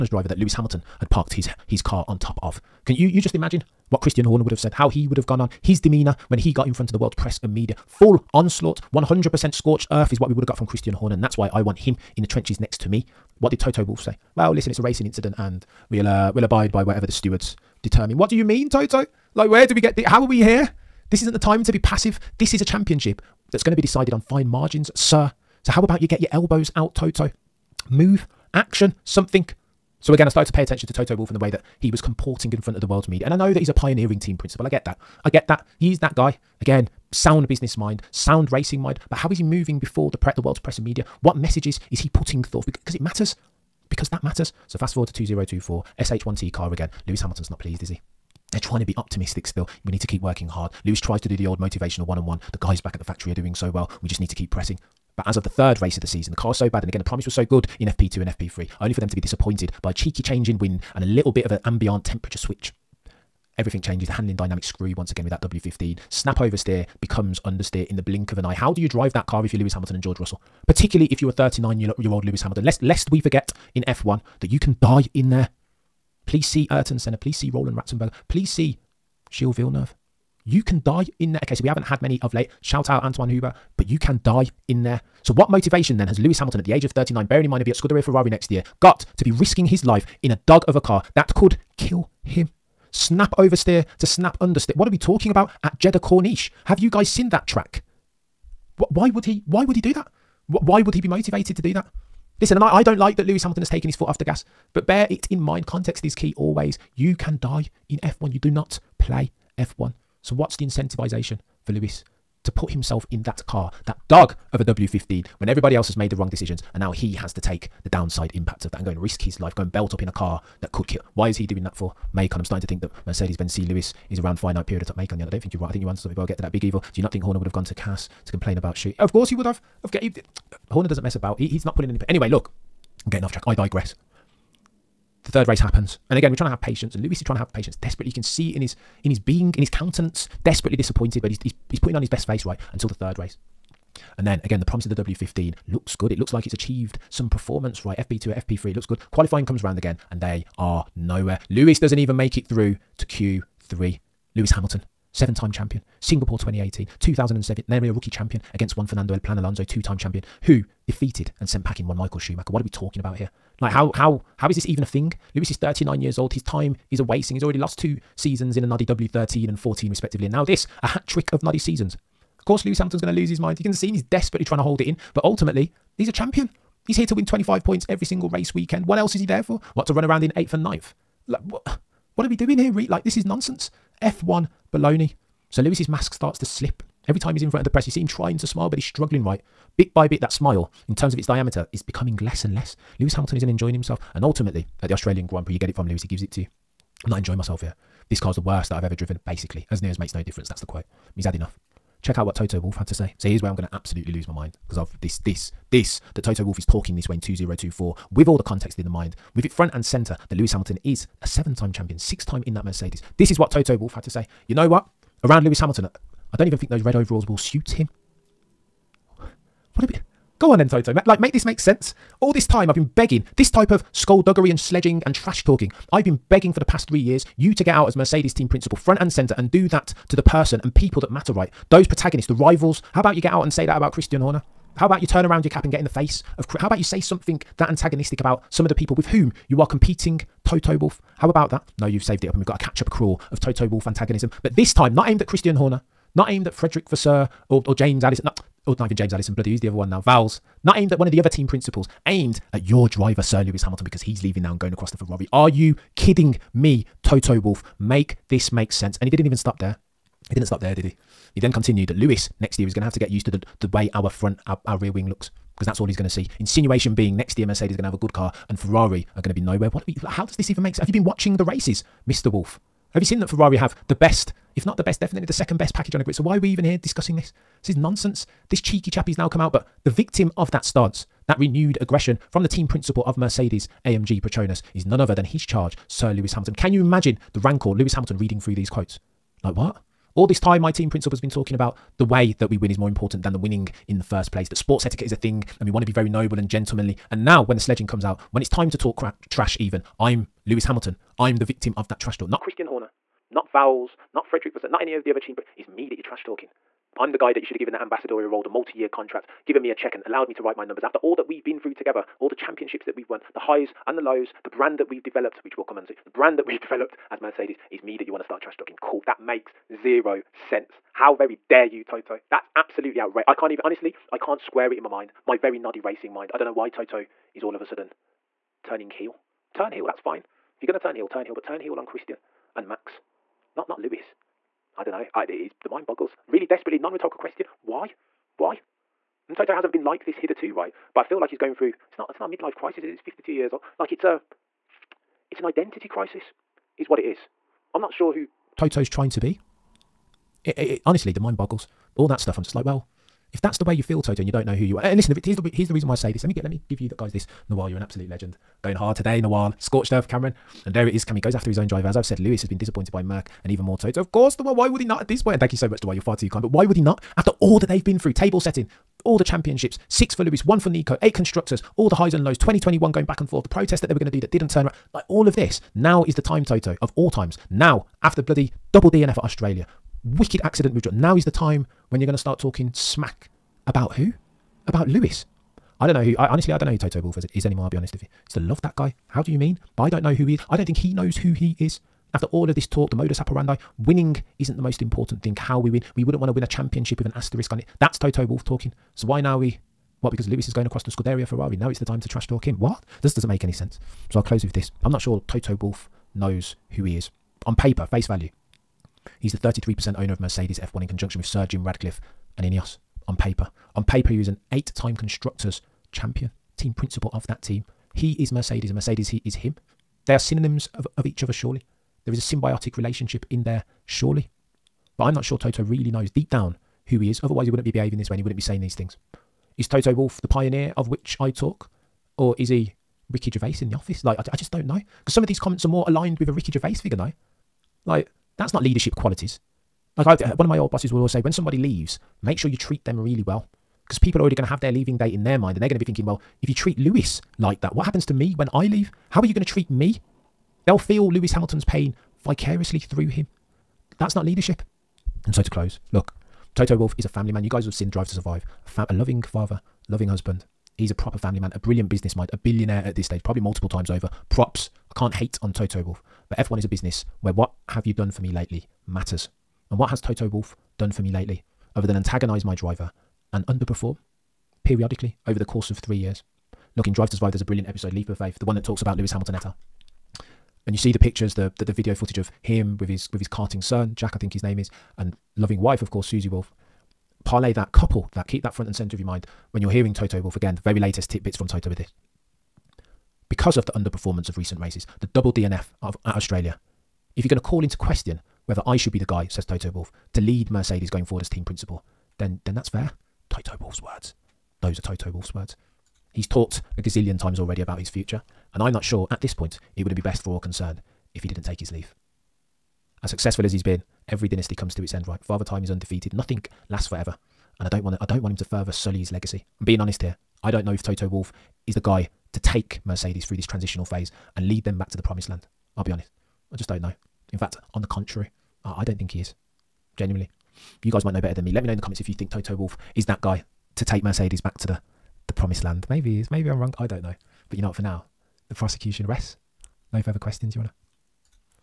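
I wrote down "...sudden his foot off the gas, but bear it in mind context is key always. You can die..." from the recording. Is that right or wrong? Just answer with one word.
wrong.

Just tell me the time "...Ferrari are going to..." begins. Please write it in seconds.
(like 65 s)
268 s.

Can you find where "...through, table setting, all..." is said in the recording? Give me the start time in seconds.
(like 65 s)
367 s.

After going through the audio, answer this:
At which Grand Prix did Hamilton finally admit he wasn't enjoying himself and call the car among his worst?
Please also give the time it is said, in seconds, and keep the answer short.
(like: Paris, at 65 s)
Australian Grand Prix, at 194 s.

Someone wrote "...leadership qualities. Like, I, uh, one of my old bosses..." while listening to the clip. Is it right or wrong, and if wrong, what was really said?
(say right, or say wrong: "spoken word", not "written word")
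right.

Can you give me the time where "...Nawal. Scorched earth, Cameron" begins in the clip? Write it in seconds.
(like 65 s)
359 s.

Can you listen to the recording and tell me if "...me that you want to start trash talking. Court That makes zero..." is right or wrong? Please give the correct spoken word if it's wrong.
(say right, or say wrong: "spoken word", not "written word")
right.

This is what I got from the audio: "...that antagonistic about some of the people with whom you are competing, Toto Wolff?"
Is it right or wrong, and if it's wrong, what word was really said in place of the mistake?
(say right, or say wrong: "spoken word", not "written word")
right.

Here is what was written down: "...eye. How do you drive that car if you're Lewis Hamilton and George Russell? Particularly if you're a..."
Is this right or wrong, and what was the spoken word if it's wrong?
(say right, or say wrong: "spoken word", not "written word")
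right.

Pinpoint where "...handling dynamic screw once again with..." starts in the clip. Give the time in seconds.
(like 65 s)
64 s.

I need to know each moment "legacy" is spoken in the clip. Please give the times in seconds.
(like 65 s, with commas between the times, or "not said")
519 s.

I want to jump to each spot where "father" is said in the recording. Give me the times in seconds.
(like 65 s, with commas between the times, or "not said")
459 s, 515 s.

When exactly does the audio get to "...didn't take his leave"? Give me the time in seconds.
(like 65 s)
511 s.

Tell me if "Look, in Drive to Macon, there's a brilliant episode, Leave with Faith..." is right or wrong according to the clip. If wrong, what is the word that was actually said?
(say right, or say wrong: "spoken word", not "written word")
wrong: "Survive", not "Macon".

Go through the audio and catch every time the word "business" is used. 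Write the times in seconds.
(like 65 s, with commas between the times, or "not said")
37 s, 461 s, 466 s.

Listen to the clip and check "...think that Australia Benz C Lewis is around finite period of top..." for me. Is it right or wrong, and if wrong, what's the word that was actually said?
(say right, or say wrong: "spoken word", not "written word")
wrong: "Mercedes", not "Australia".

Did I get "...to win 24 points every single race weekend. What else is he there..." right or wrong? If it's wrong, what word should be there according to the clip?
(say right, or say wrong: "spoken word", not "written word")
wrong: "25", not "24".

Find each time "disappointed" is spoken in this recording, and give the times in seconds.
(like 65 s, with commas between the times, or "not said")
59 s, 140 s, 362 s.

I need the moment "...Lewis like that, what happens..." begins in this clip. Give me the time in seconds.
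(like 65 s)
446 s.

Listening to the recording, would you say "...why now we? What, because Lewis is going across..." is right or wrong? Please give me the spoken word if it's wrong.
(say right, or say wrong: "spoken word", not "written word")
right.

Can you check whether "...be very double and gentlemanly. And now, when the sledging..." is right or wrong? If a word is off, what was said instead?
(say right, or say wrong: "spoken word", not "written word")
wrong: "noble", not "double".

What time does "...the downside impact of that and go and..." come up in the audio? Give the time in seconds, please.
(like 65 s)
117 s.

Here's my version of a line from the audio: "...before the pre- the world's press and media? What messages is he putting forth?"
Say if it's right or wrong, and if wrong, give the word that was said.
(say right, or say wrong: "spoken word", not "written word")
right.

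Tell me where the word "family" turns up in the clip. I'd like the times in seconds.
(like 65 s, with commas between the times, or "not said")
457 s, 461 s.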